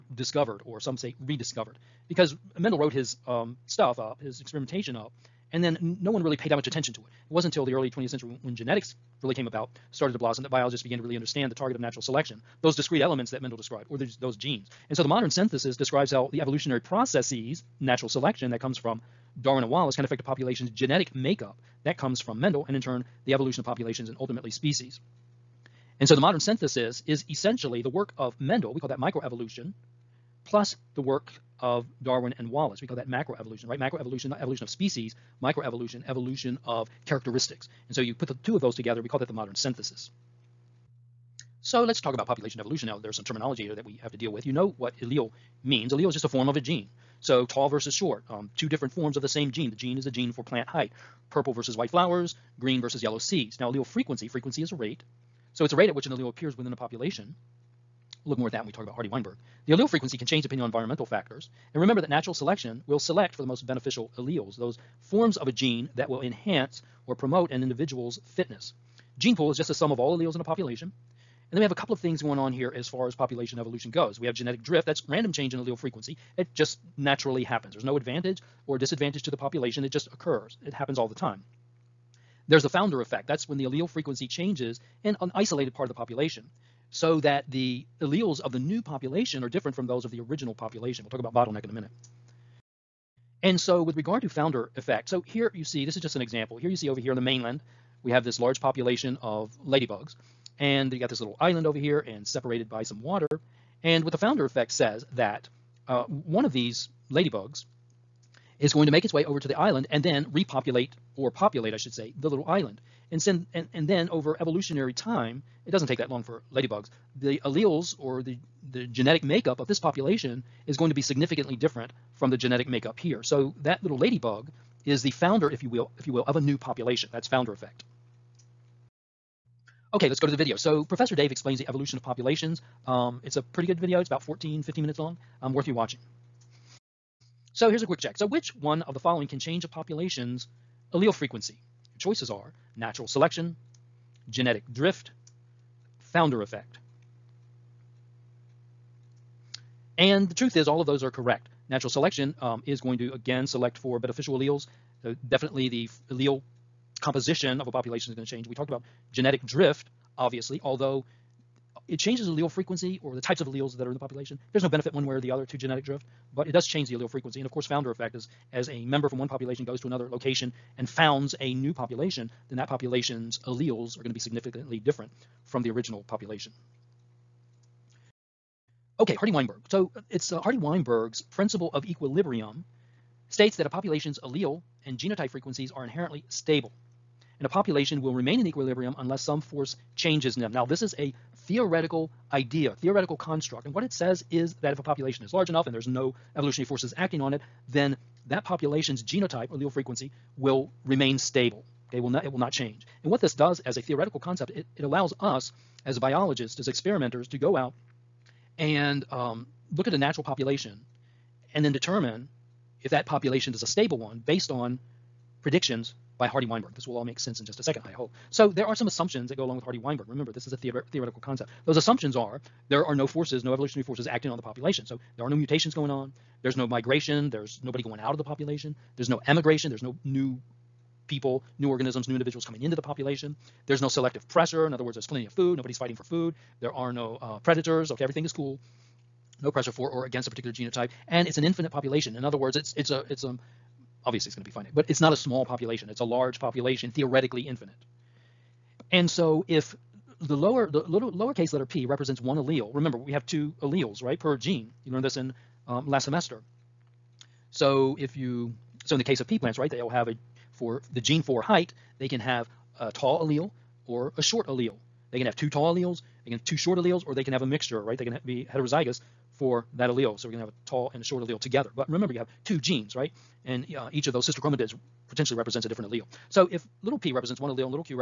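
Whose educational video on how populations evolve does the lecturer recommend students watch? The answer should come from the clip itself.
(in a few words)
Professor Dave.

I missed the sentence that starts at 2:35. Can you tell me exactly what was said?
So definitely the allele composition of a population is going to change.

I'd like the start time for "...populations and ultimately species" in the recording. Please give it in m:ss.
0:23.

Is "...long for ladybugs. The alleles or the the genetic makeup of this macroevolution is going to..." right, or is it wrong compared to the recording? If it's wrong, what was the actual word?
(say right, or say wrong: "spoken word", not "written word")
wrong: "population", not "macroevolution".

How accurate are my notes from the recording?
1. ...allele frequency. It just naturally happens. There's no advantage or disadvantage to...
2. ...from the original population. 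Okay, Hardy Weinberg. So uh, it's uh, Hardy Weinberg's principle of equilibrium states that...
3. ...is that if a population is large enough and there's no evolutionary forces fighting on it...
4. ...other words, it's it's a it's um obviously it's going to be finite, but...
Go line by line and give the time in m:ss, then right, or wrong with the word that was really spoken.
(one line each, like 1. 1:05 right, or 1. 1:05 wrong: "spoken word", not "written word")
1. 1:15 right
2. 2:55 right
3. 3:14 wrong: "acting", not "fighting"
4. 4:02 right.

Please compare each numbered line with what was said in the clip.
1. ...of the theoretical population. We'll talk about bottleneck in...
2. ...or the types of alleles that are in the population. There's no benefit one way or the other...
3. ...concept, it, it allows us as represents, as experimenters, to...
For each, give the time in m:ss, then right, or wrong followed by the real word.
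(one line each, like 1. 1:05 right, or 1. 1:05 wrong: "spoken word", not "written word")
1. 1:30 wrong: "original", not "theoretical"
2. 2:43 right
3. 3:24 wrong: "biologists", not "represents".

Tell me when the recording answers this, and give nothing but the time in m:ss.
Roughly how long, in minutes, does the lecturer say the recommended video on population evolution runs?
2:14.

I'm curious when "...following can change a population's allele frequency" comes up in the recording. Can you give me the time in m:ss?
2:18.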